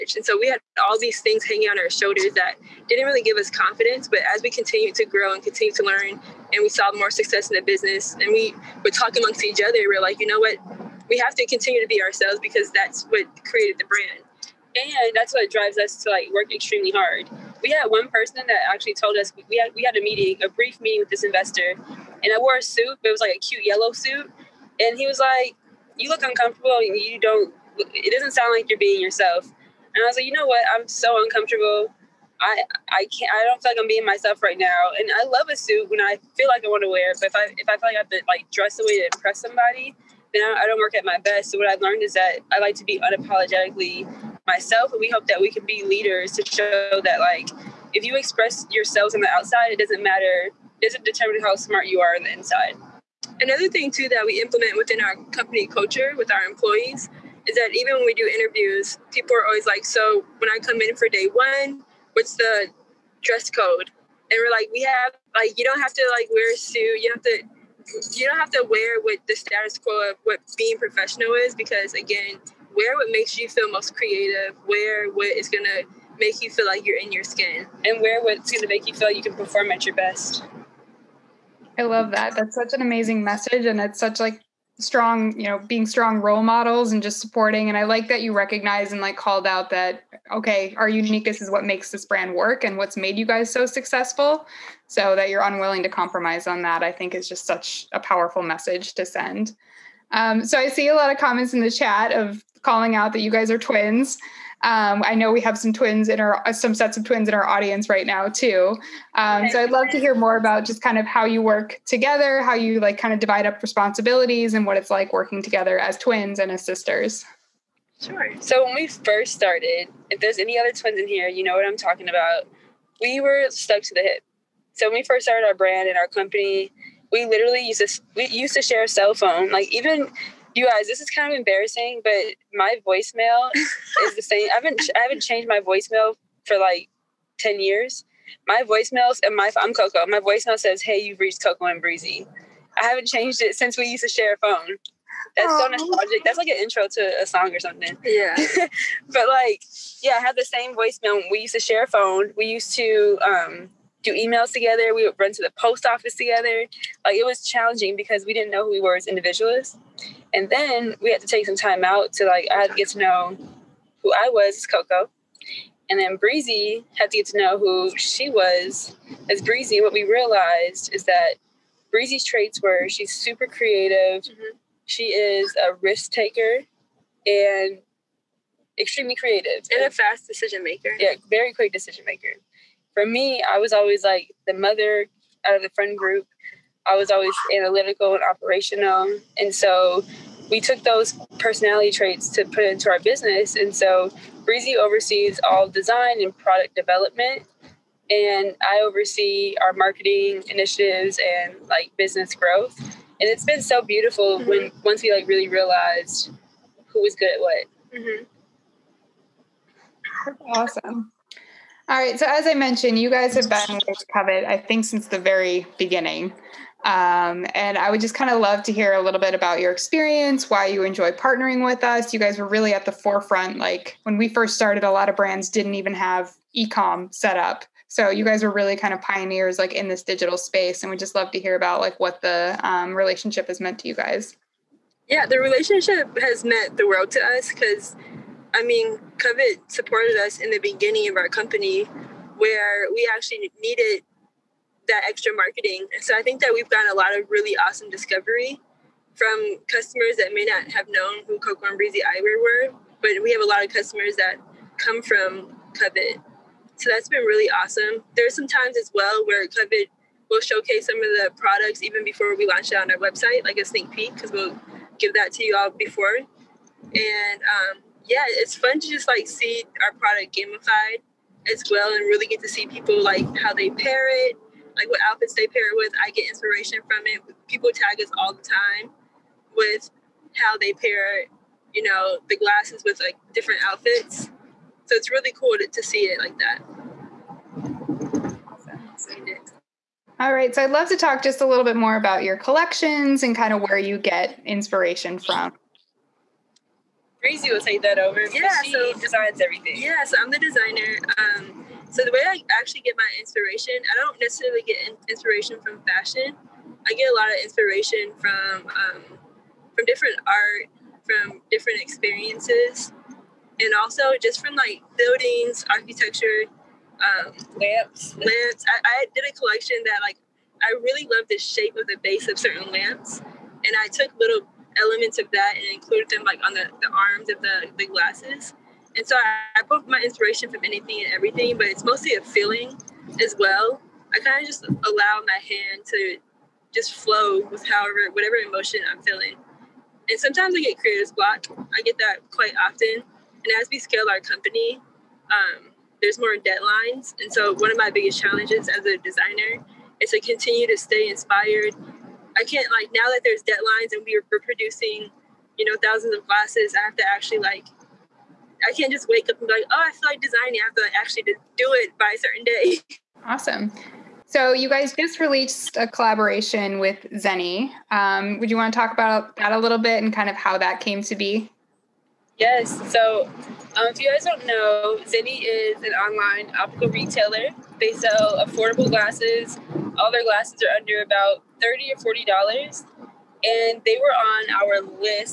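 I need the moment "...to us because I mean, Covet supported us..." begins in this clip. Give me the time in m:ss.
3:57.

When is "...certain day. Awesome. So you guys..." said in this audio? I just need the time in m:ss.
6:02.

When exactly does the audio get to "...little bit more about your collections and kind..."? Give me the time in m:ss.
4:51.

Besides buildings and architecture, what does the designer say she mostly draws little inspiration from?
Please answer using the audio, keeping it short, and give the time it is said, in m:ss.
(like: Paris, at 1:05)
Fashion, at 5:05.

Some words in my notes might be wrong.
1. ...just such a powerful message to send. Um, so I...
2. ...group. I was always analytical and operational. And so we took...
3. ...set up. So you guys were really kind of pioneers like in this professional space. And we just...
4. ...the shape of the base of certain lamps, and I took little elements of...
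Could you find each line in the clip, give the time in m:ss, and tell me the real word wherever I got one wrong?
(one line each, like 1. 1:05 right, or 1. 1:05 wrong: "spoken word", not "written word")
1. 1:37 right
2. 3:05 right
3. 3:47 wrong: "digital", not "professional"
4. 5:21 right.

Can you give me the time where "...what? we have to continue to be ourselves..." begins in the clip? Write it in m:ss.
0:10.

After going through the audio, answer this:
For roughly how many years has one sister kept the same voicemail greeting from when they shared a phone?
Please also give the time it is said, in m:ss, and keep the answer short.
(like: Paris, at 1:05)
10 years, at 2:17.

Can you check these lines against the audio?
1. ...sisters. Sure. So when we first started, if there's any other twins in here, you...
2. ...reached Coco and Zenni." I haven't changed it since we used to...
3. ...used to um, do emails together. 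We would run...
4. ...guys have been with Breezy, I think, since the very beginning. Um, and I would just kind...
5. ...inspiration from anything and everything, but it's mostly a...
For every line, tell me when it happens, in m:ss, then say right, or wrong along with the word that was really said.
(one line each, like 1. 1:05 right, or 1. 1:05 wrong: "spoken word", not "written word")
1. 1:56 right
2. 2:21 wrong: "Breezy", not "Zenni"
3. 2:32 right
4. 3:33 wrong: "Covet", not "Breezy"
5. 5:29 right.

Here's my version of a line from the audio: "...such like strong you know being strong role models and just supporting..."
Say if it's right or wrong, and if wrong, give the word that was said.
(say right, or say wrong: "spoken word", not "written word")
right.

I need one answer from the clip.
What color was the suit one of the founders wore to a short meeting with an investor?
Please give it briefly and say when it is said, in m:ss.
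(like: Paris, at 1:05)
Yellow, at 0:23.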